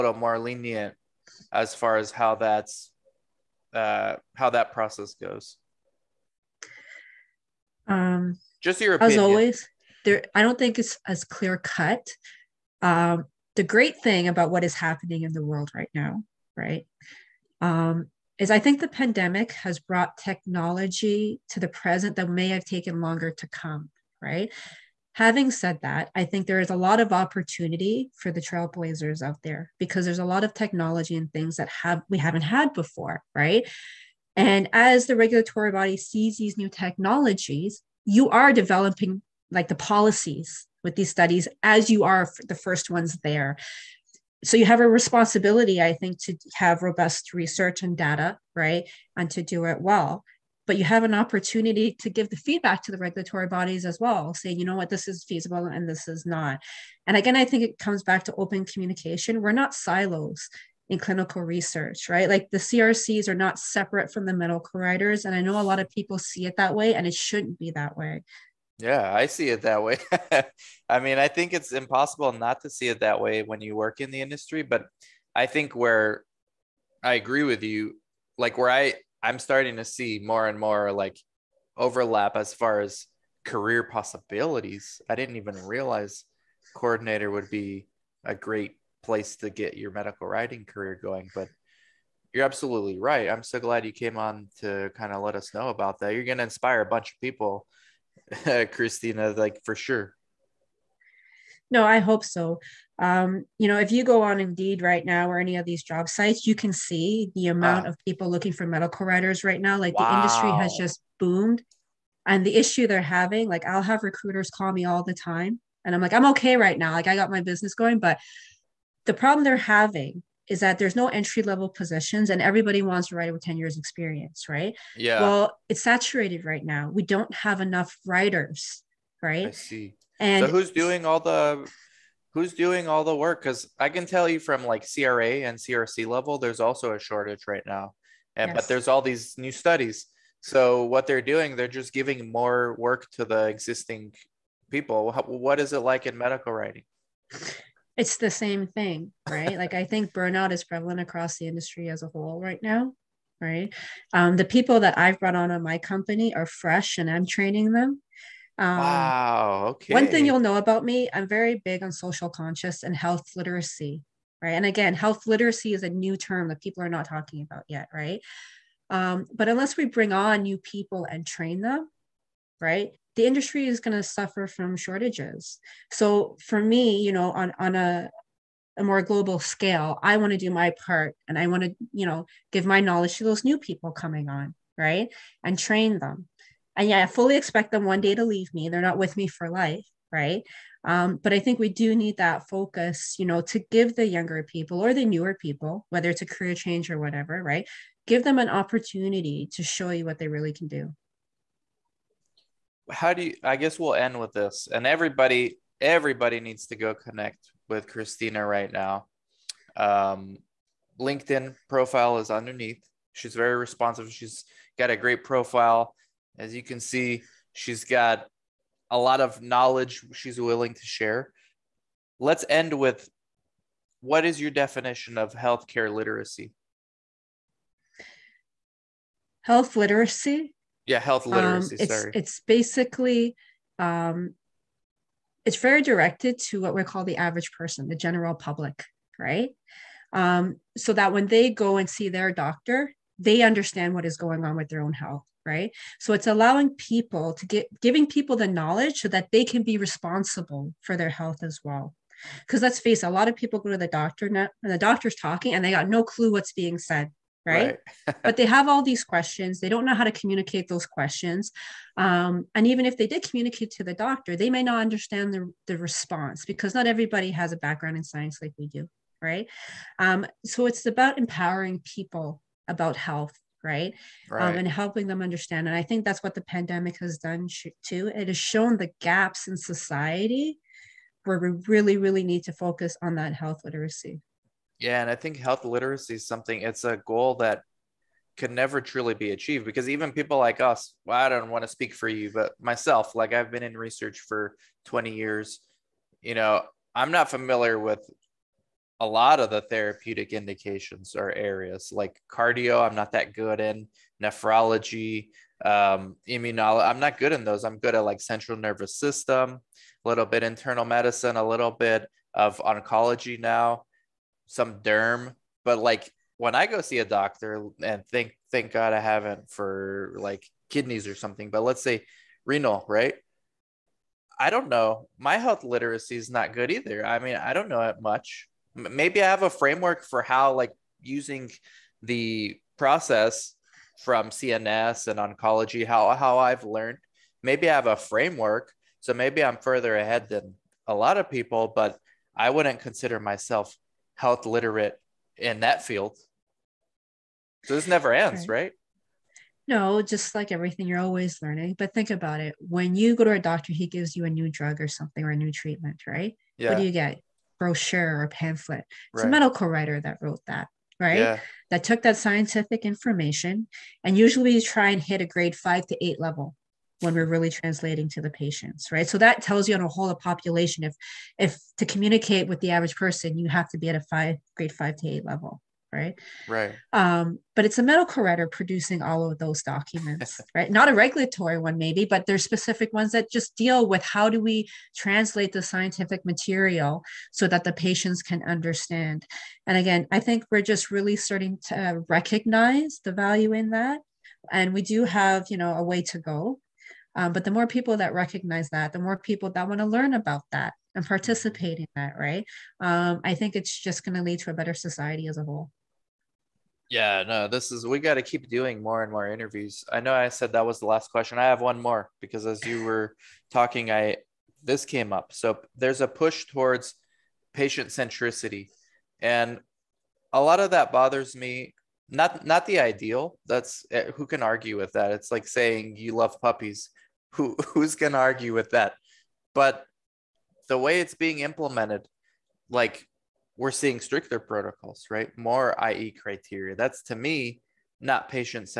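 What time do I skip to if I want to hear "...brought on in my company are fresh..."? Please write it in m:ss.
2:35.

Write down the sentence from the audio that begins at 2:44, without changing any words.
And again, health literacy is a new term that people are not talking about yet, right?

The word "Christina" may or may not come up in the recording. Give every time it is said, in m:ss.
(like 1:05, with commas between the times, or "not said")
1:38, 3:27.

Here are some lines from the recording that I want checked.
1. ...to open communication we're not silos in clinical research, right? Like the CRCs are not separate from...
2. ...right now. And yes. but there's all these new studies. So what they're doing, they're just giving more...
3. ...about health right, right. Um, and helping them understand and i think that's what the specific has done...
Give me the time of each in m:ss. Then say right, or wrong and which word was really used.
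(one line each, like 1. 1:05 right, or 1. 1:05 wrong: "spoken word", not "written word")
1. 0:58 right
2. 2:17 right
3. 4:32 wrong: "pandemic", not "specific".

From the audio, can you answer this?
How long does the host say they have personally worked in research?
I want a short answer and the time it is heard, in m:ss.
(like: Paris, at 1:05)
20 years, at 4:54.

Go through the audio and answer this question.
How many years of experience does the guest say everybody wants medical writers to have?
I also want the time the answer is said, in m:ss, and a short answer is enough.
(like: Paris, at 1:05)
10 years, at 2:03.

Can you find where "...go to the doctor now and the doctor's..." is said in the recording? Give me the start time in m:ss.
4:13.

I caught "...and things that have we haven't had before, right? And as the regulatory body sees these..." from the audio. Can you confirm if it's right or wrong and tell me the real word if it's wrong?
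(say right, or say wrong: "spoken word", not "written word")
right.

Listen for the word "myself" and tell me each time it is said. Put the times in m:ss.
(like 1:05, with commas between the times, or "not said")
4:52, 5:43.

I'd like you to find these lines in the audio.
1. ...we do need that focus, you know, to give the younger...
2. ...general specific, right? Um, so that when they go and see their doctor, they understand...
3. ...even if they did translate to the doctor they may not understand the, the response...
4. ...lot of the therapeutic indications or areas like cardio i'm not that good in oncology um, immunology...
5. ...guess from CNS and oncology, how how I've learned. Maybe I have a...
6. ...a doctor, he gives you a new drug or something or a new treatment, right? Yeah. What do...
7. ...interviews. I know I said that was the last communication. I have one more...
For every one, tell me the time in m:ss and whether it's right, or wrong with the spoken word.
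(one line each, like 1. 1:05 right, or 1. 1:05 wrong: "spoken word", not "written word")
1. 3:11 right
2. 3:57 wrong: "public", not "specific"
3. 4:22 wrong: "communicate", not "translate"
4. 4:59 wrong: "nephrology", not "oncology"
5. 5:32 wrong: "process", not "guess"
6. 5:53 right
7. 6:49 wrong: "question", not "communication".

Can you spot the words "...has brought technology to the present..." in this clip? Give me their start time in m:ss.
0:19.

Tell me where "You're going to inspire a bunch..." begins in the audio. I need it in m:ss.
1:36.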